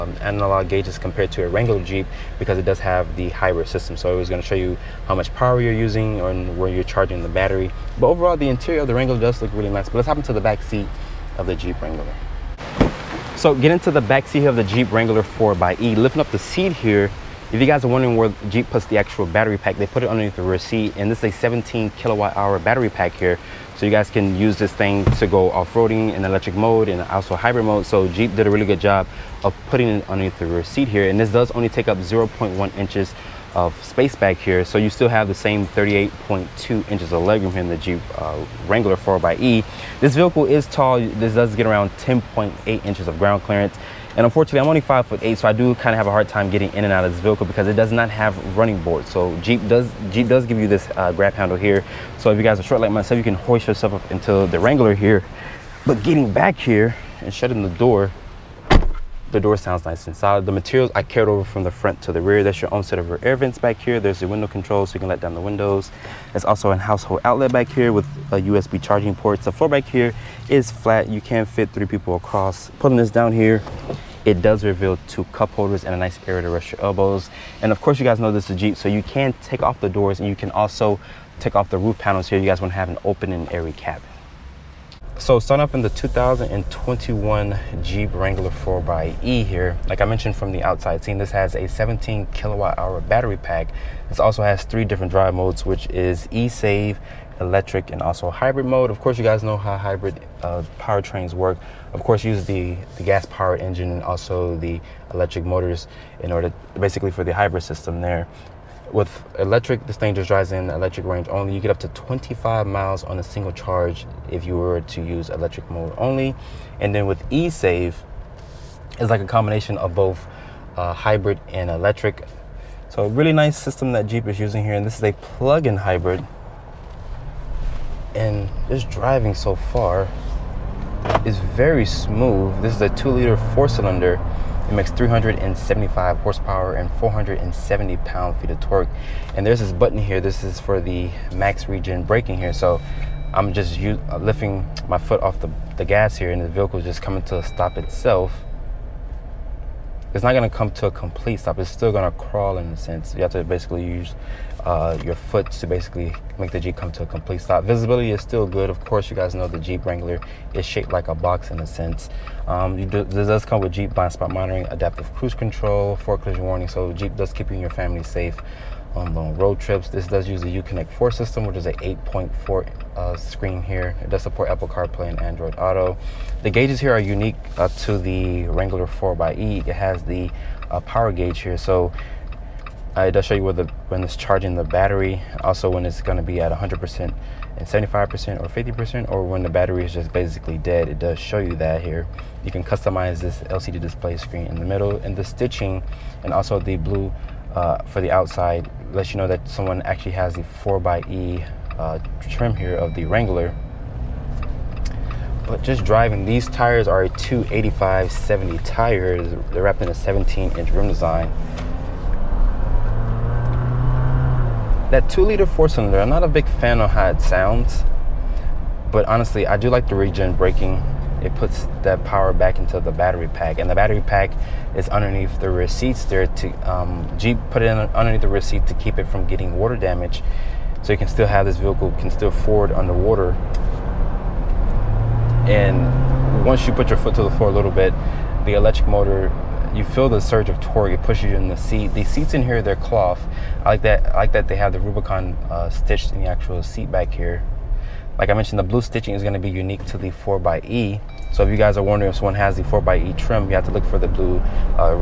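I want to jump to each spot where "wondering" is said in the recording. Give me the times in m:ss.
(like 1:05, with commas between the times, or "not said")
0:17, 4:11.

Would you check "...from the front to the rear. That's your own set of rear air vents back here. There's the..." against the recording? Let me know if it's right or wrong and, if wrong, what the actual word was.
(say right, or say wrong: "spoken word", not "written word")
right.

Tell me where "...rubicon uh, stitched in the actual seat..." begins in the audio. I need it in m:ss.
4:04.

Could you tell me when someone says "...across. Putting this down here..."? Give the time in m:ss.
1:12.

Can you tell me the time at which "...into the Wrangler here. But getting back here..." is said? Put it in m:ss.
0:54.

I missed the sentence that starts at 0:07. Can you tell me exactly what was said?
But overall, the interior of the Wrangler does look really nice.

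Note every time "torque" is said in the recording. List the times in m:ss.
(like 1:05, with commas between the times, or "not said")
2:18, 4:00.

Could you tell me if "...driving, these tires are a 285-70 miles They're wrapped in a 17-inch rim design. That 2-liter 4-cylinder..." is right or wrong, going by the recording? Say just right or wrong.
wrong.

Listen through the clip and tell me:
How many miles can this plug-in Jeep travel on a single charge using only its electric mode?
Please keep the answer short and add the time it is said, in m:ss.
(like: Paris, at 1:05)
25 miles, at 1:51.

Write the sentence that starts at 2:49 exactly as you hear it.
This does use the Uconnect 4 system, which is a 8.4 uh, screen here.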